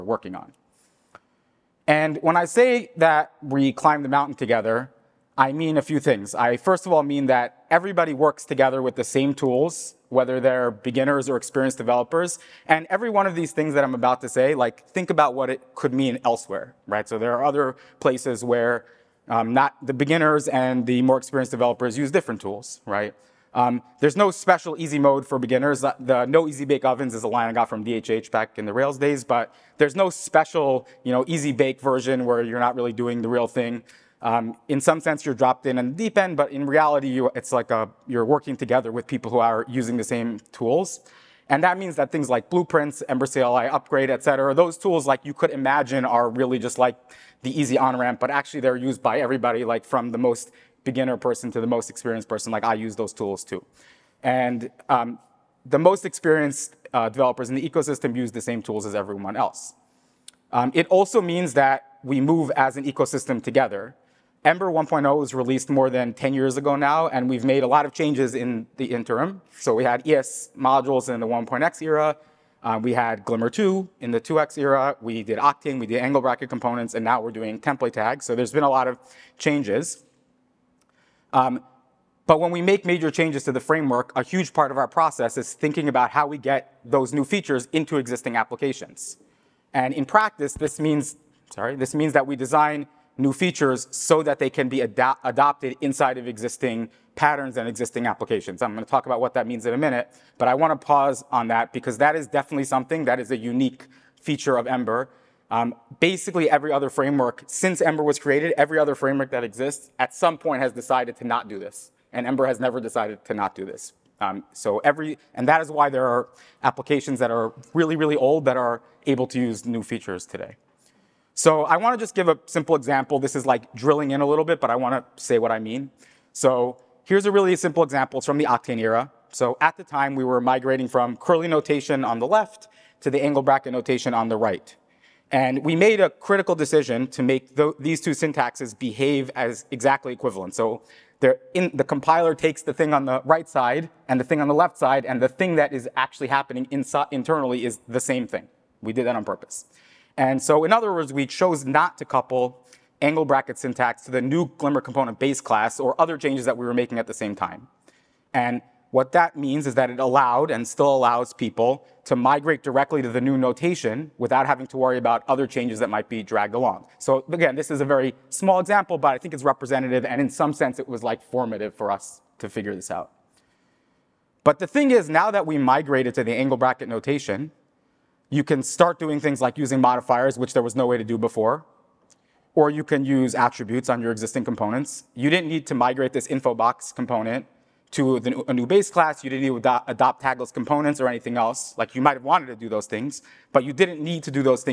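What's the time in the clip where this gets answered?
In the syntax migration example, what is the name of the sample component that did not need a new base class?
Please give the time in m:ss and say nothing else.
3:06.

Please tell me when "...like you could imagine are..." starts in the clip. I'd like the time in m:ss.
0:45.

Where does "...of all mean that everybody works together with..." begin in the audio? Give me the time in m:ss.
0:06.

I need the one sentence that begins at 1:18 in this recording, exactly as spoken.
So there's been a lot of changes.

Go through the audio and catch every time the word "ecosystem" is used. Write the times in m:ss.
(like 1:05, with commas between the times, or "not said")
0:57, 1:02.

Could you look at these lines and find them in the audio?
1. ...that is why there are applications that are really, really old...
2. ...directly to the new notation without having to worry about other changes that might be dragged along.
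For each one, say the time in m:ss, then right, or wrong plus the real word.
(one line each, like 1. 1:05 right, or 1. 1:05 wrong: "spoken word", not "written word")
1. 1:55 right
2. 2:42 right.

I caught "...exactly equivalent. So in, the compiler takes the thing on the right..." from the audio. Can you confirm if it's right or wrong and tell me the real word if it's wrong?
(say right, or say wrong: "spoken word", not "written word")
right.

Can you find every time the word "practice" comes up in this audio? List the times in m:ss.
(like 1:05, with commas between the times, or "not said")
1:30.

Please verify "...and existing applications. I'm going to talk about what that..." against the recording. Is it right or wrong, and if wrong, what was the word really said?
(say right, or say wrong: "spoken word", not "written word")
right.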